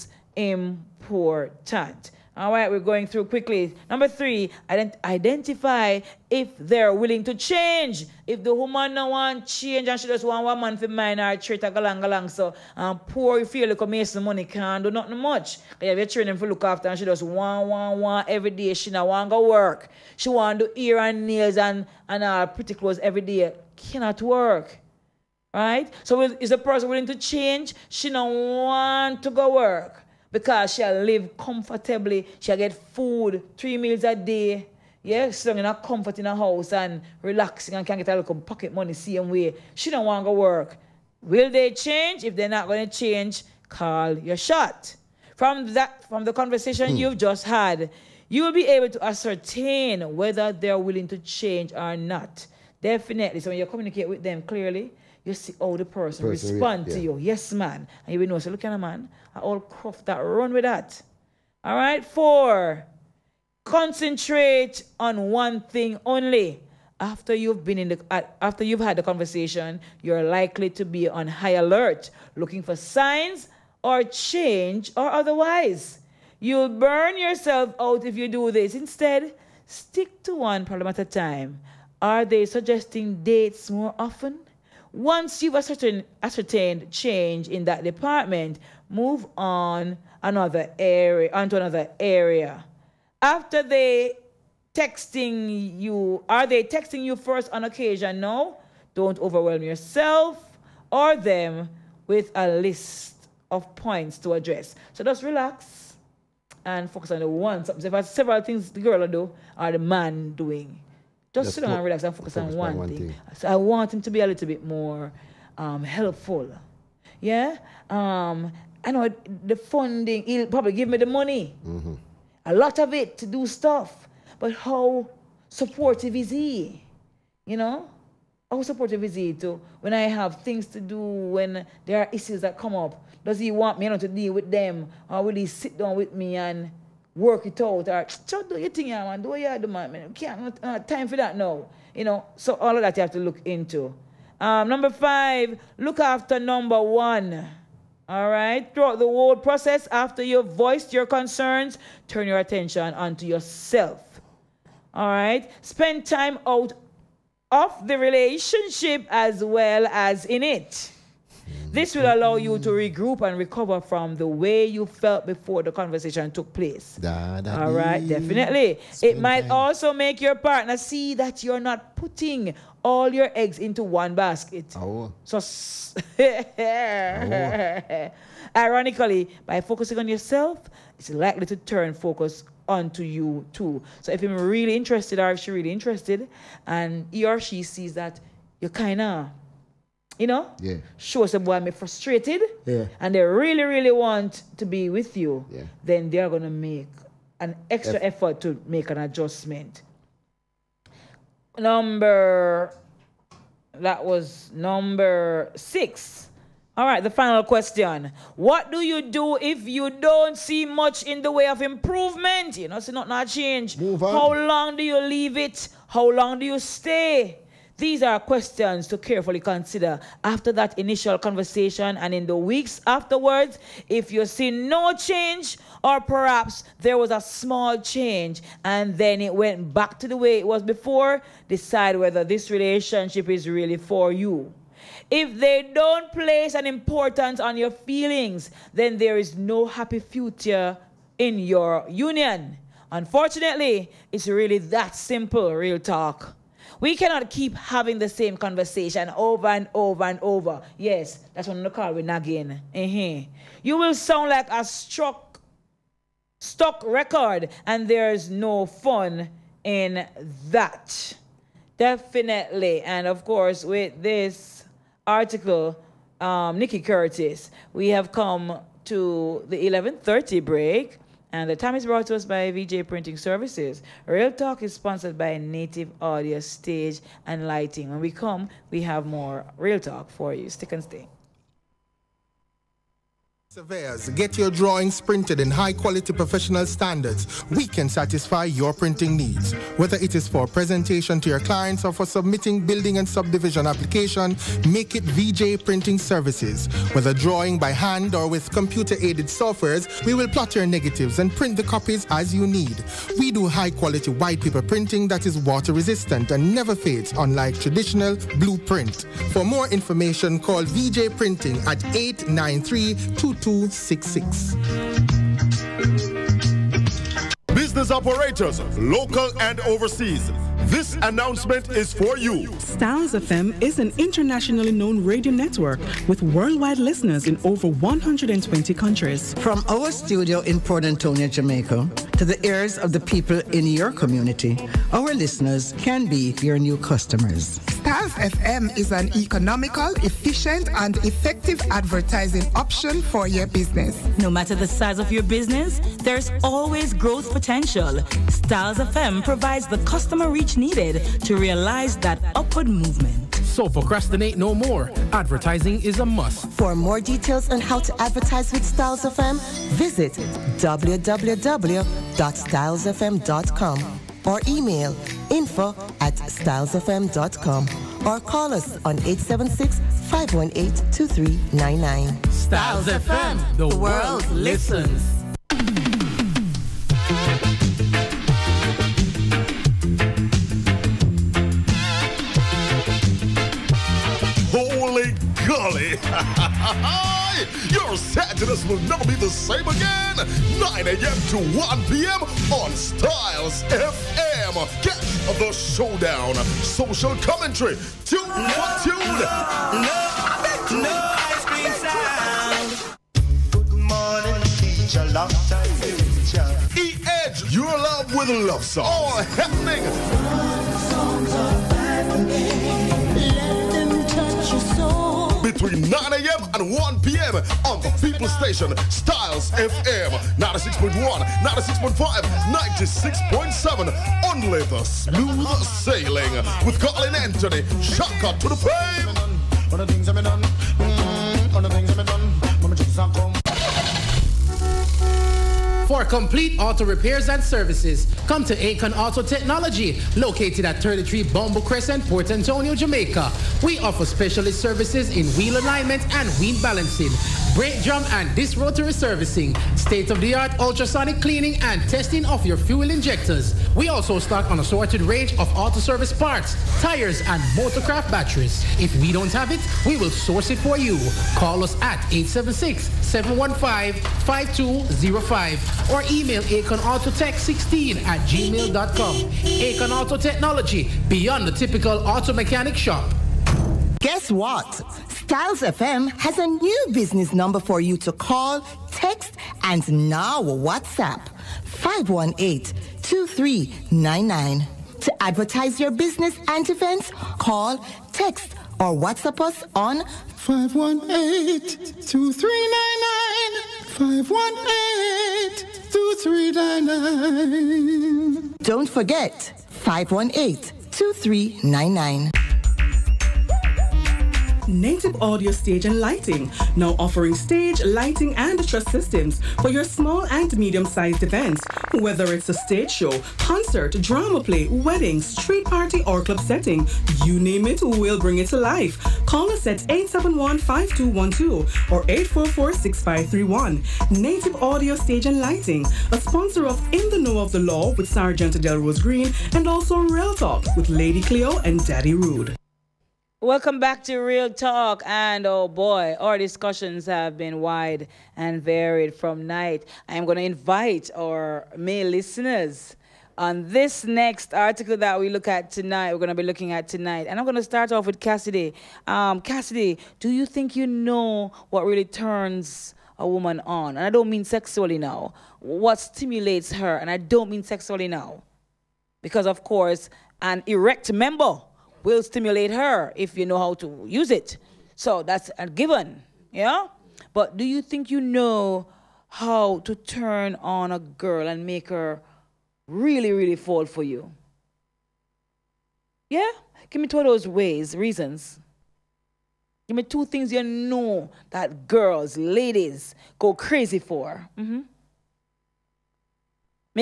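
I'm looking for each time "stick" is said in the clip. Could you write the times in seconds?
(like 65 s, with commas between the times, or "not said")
79 s, 280 s.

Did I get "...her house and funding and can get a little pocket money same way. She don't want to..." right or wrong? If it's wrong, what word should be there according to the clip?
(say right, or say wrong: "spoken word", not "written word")
wrong: "relaxing", not "funding".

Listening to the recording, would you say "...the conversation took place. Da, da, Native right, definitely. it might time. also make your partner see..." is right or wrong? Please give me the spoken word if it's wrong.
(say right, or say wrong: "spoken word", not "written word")
wrong: "All", not "Native".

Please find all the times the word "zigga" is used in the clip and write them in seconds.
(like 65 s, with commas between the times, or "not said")
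not said.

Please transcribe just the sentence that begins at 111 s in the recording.
Just, just sit down and relax and focus, focus on one, one thing.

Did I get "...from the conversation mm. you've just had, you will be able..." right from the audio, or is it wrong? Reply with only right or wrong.
right.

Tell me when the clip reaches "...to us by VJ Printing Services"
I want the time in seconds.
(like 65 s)
272 s.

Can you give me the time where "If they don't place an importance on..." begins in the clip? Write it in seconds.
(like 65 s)
235 s.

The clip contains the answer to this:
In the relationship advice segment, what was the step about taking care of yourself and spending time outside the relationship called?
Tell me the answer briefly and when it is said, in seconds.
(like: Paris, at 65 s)
Look after number one, at 145 s.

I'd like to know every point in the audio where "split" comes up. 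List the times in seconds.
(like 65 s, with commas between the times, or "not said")
not said.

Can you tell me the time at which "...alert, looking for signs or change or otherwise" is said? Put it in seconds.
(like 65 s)
71 s.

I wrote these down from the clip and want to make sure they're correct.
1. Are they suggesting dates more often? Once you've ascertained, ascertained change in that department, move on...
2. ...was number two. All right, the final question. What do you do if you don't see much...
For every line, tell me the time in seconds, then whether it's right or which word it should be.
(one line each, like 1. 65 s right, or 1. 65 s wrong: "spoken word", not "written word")
1. 82 s right
2. 204 s wrong: "six", not "two".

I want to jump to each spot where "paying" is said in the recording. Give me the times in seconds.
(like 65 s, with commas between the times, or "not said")
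not said.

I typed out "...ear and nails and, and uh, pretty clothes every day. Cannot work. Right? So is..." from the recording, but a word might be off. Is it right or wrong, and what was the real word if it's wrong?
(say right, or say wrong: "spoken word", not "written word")
right.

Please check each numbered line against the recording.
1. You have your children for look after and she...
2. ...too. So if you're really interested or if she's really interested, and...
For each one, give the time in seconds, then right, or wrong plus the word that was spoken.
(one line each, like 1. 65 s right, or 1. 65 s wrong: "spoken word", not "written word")
1. 15 s right
2. 183 s right.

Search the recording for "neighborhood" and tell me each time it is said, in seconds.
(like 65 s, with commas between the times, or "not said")
not said.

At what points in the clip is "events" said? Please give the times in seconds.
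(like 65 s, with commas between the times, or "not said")
486 s, 511 s.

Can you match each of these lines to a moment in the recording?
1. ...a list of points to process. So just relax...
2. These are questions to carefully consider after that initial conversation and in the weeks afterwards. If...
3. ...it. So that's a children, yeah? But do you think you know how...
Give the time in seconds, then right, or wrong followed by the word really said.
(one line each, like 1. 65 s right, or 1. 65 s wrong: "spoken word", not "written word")
1. 102 s wrong: "address", not "process"
2. 217 s right
3. 564 s wrong: "given", not "children".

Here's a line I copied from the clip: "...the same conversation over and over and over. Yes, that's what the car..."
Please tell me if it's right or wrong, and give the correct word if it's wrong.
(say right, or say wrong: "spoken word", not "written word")
right.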